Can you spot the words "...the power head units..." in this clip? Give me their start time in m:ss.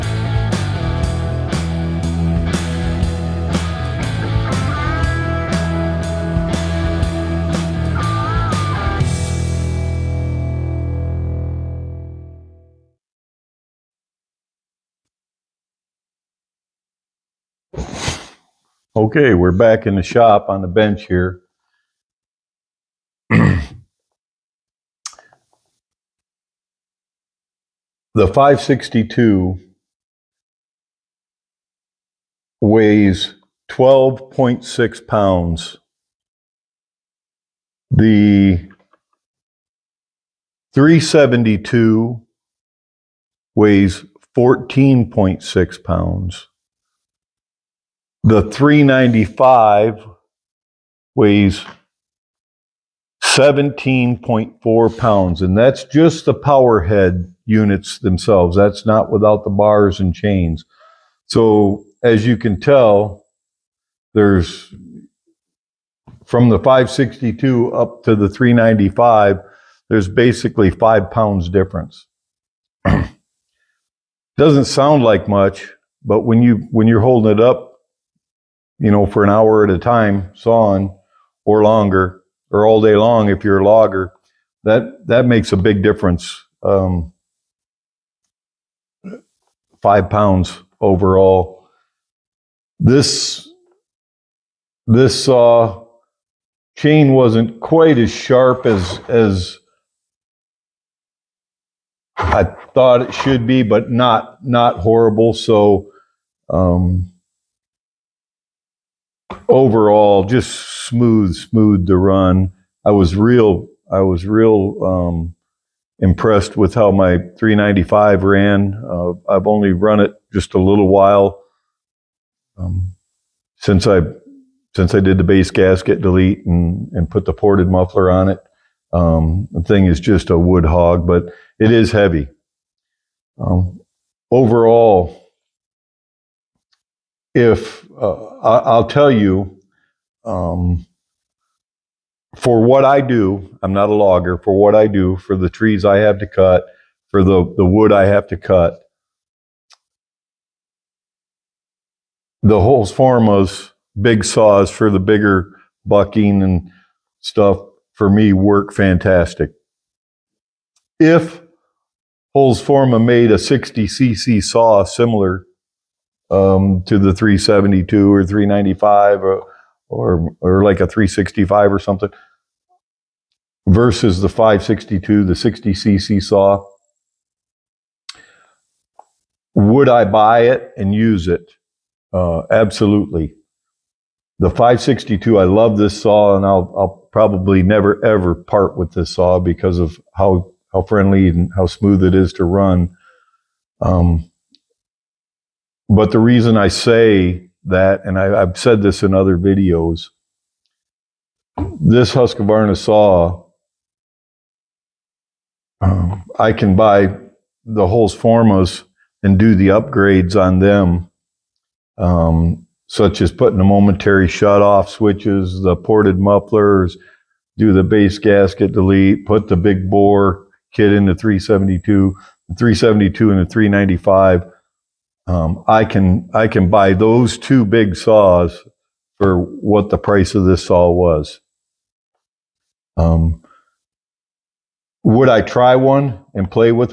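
0:56.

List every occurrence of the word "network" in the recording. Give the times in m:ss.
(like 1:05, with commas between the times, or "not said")
not said.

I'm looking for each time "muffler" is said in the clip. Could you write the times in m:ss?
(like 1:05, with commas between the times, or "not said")
2:07, 3:36.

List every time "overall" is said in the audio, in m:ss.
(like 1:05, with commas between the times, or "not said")
1:30, 1:49, 2:14.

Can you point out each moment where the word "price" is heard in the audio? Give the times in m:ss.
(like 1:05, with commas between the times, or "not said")
3:49.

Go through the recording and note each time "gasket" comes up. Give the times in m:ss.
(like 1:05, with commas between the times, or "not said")
2:05, 3:38.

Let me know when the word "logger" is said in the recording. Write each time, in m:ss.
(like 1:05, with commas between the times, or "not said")
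1:23, 2:23.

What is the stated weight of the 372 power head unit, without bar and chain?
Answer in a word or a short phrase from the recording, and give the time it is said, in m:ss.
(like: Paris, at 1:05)
14.6 pounds, at 0:44.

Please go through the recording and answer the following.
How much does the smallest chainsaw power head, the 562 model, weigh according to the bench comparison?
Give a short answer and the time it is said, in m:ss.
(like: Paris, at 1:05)
12.6 pounds, at 0:33.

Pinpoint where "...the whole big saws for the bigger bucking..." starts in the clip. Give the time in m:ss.
2:32.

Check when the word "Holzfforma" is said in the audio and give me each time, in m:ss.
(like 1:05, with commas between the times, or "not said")
2:42, 3:27.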